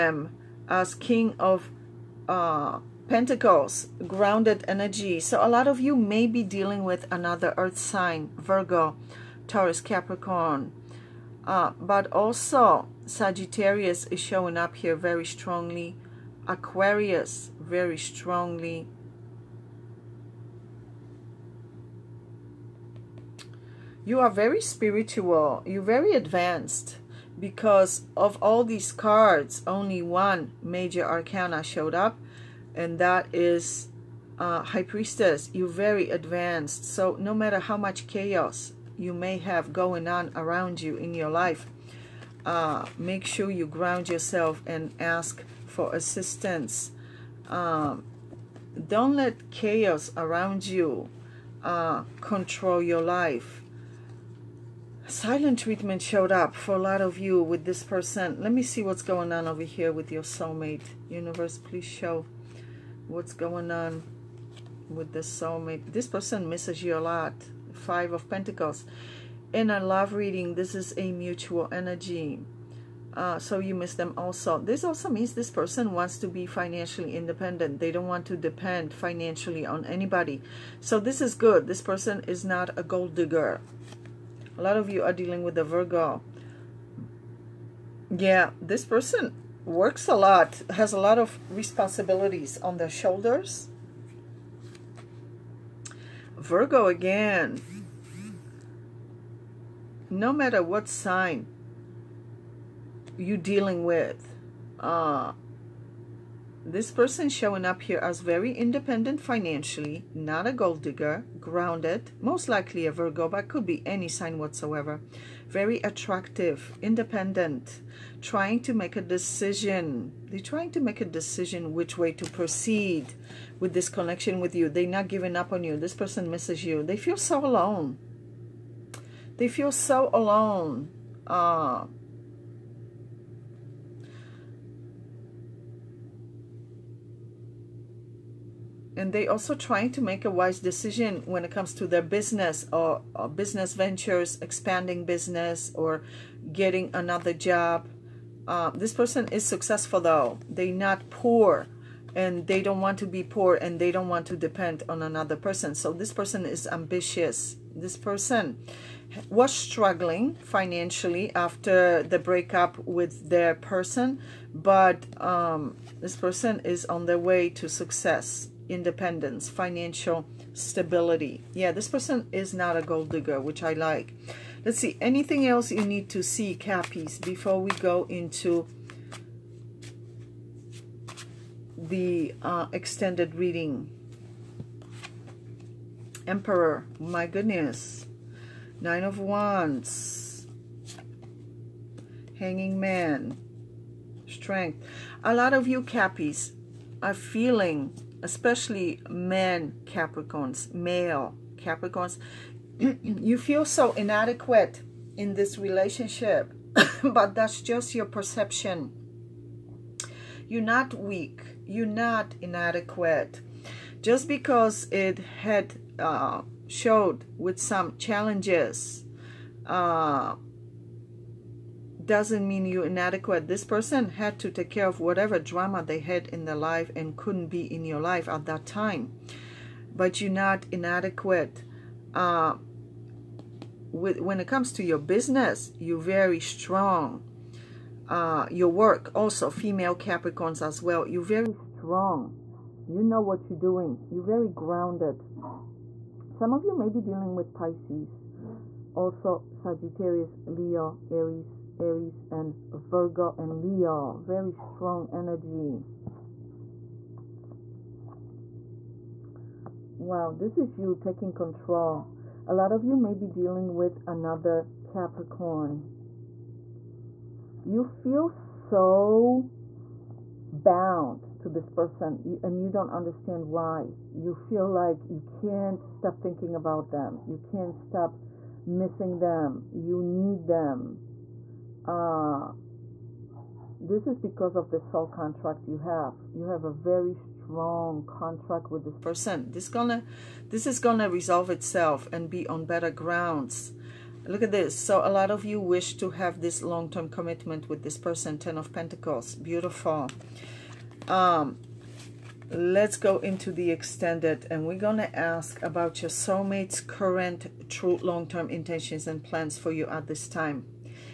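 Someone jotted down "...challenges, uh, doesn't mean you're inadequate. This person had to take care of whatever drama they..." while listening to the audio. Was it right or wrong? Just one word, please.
right.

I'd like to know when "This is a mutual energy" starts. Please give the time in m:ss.
1:10.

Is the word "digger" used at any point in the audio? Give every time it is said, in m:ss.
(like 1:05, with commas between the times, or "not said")
1:23, 1:50, 2:53.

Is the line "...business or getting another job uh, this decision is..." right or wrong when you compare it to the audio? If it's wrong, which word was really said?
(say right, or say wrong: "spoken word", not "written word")
wrong: "person", not "decision".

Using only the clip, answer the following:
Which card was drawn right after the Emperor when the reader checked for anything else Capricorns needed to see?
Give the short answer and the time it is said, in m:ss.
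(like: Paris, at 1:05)
Nine of Wands, at 3:08.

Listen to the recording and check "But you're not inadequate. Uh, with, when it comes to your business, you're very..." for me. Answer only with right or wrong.
right.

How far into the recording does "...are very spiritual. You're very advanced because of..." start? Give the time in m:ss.
0:24.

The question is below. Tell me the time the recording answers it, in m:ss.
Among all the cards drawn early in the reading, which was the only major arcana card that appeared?
0:34.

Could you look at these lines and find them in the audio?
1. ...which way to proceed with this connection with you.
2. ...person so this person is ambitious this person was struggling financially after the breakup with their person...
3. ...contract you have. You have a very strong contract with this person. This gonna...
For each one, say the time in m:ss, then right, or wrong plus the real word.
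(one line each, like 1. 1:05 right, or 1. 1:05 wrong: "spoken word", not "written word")
1. 2:01 right
2. 2:35 right
3. 4:45 right.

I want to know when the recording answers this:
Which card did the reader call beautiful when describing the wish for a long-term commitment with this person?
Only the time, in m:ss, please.
4:58.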